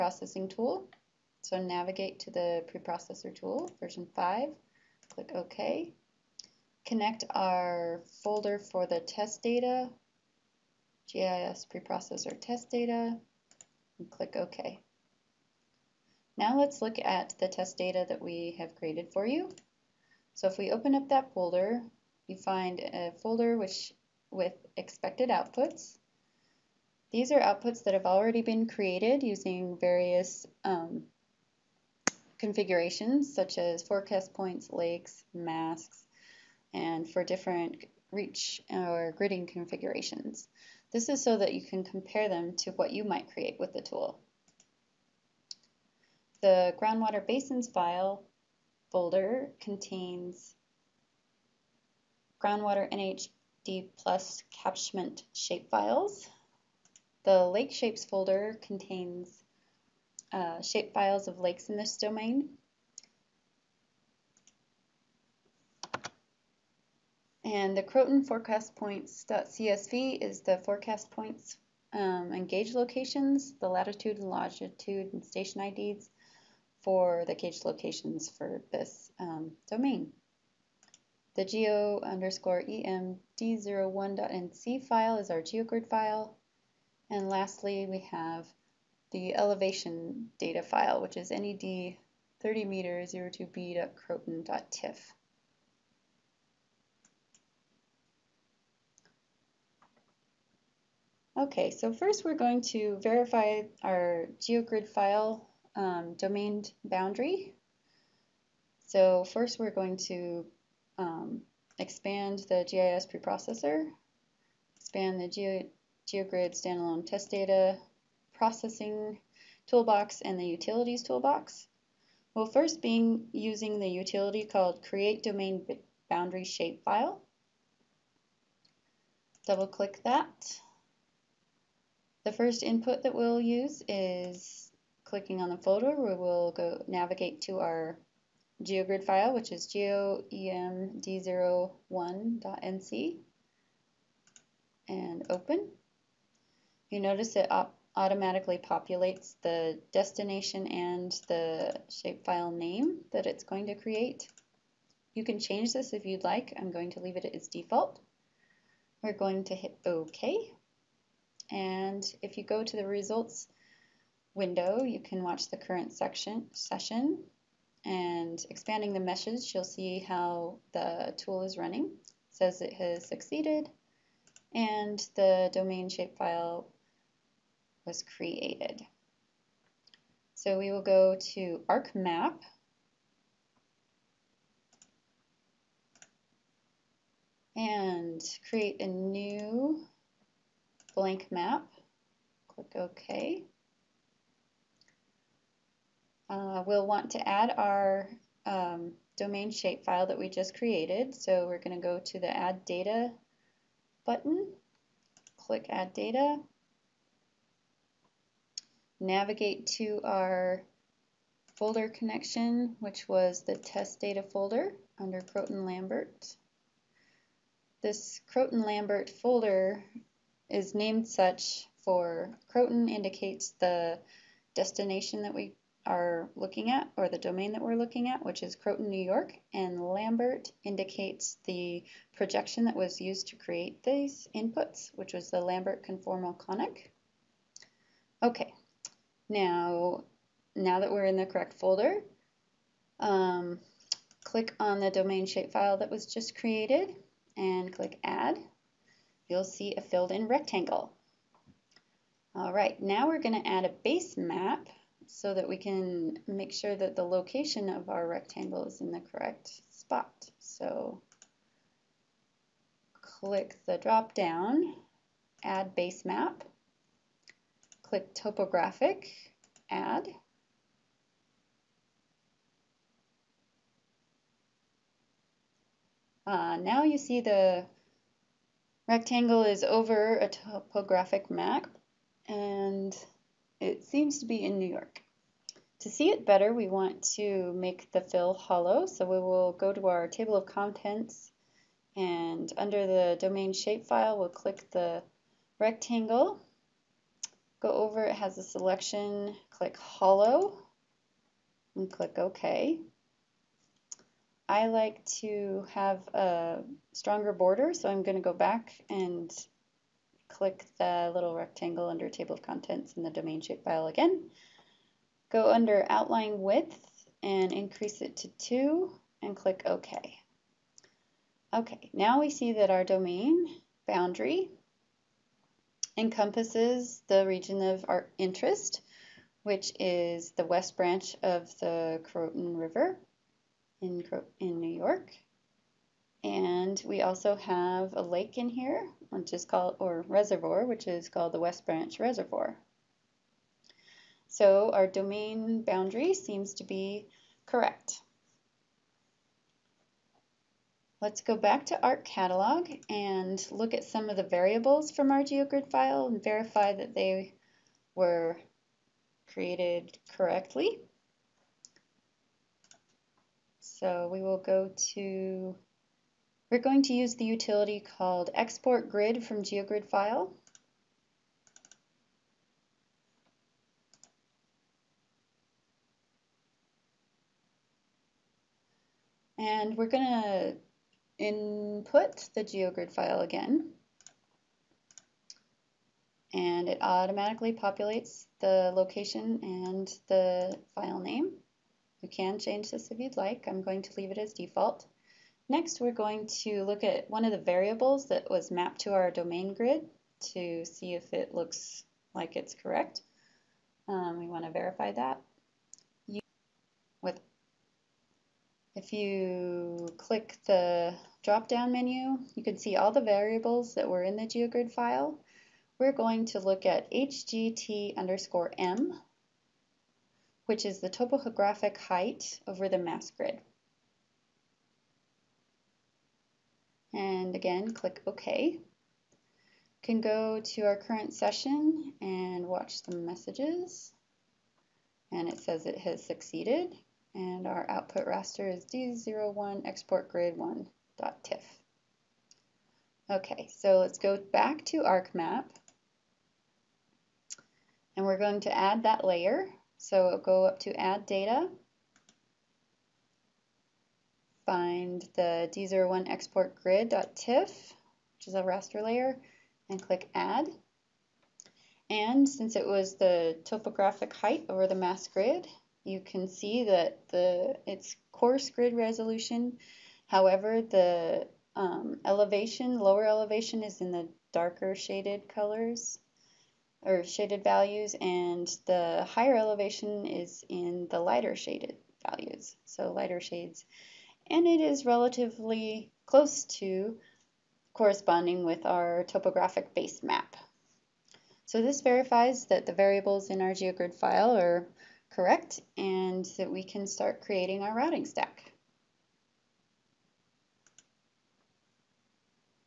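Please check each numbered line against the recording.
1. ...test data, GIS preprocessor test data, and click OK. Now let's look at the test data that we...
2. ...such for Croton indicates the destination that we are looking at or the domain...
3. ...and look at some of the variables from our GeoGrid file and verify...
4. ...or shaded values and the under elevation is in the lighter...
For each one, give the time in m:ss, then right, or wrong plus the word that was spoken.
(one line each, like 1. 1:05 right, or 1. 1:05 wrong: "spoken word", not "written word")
1. 0:09 right
2. 3:41 right
3. 5:52 right
4. 7:56 wrong: "higher", not "under".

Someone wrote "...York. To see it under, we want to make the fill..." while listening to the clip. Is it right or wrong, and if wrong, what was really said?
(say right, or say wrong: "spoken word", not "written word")
wrong: "better", not "under".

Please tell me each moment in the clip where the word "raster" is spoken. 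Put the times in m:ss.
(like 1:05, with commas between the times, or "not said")
7:18, 7:38.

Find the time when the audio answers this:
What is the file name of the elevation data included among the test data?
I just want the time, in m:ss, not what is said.
1:31.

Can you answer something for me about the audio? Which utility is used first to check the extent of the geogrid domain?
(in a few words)
create domain boundary shapefile.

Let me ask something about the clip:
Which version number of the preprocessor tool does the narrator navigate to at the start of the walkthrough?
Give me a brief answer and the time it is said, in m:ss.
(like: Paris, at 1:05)
5, at 0:03.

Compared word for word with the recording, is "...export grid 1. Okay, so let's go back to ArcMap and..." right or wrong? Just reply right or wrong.
right.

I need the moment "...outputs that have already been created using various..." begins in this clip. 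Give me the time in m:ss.
0:27.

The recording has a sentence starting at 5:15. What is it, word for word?
Go under outline width and increase it to 2 and click OK.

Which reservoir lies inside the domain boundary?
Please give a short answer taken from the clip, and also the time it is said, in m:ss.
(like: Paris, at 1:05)
West Branch Reservoir, at 5:41.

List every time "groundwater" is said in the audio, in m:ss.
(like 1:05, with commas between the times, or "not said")
0:46, 0:52.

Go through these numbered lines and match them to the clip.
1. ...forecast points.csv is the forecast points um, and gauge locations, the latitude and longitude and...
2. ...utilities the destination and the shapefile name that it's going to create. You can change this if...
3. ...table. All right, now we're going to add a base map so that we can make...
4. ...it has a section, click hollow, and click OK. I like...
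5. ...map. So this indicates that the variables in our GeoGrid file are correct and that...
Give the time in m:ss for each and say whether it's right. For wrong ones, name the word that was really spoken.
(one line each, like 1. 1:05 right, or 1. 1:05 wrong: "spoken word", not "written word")
1. 1:08 right
2. 2:28 wrong: "populates", not "utilities"
3. 4:10 wrong: "rectangle", not "table"
4. 4:58 wrong: "selection", not "section"
5. 8:10 wrong: "verifies", not "indicates".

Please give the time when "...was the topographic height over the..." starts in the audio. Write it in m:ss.
7:42.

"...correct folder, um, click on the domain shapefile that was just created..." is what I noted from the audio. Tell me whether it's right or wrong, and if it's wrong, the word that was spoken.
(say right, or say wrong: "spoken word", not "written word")
right.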